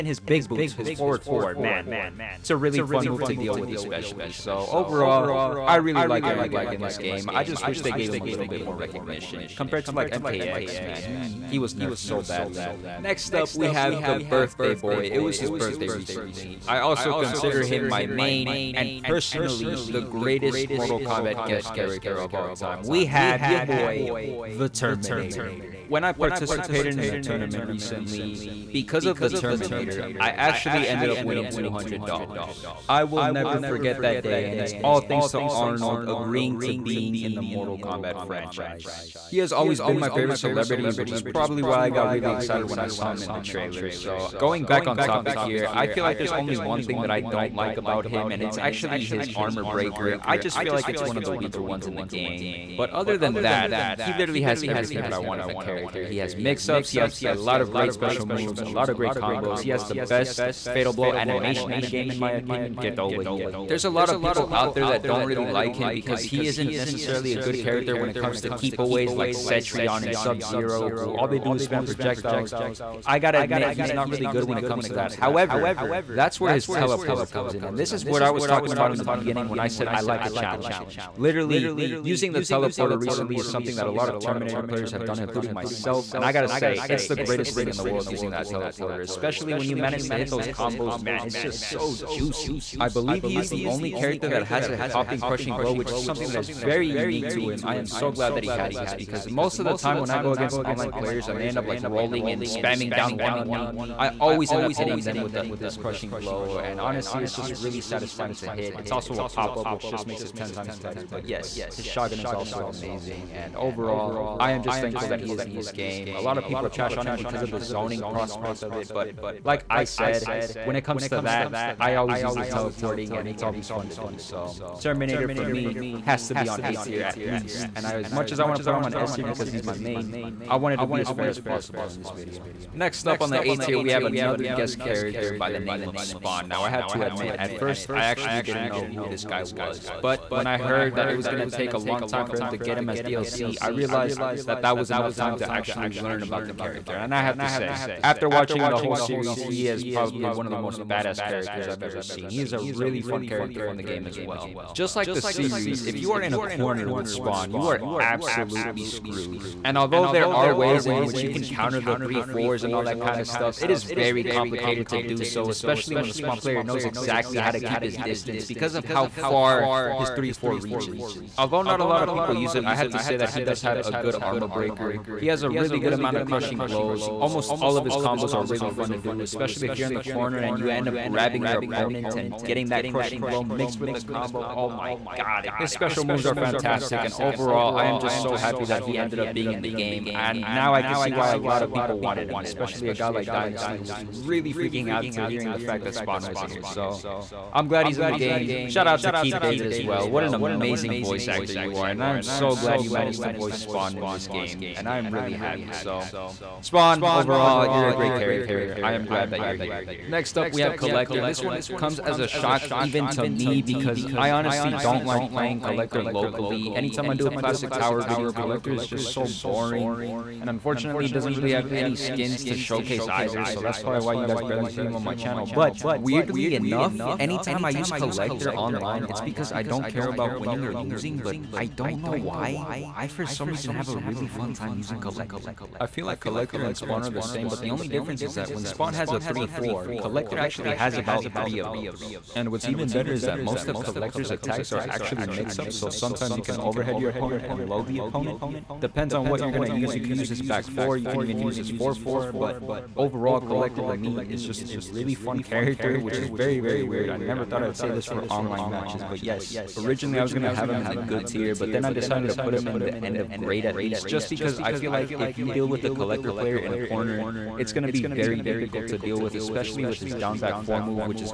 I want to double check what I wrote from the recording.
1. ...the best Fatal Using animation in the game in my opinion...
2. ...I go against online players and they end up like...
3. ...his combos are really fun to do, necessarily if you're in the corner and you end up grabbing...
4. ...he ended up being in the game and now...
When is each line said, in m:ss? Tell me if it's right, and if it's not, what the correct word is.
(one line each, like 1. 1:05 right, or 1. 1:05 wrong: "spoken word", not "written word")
1. 0:59 wrong: "Blow", not "Using"
2. 1:40 right
3. 2:57 wrong: "especially", not "necessarily"
4. 3:08 right.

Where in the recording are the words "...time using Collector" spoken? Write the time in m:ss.
3:54.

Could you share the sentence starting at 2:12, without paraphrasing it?
Next up on the A tier, we have another guest character by the name of Spawn.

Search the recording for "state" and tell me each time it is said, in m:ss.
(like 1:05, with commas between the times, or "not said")
not said.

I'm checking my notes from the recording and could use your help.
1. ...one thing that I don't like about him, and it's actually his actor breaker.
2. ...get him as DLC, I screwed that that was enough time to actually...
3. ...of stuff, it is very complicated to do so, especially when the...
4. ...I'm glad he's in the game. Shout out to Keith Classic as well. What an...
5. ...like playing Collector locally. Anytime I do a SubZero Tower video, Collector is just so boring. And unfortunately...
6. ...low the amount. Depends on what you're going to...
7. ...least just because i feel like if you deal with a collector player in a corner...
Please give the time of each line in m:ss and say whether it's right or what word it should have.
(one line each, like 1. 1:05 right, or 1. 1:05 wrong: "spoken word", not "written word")
1. 0:46 wrong: "armor", not "actor"
2. 2:22 wrong: "realized", not "screwed"
3. 2:43 right
4. 3:17 wrong: "David", not "Classic"
5. 3:35 wrong: "Classic", not "SubZero"
6. 4:07 wrong: "opponent", not "amount"
7. 4:23 right.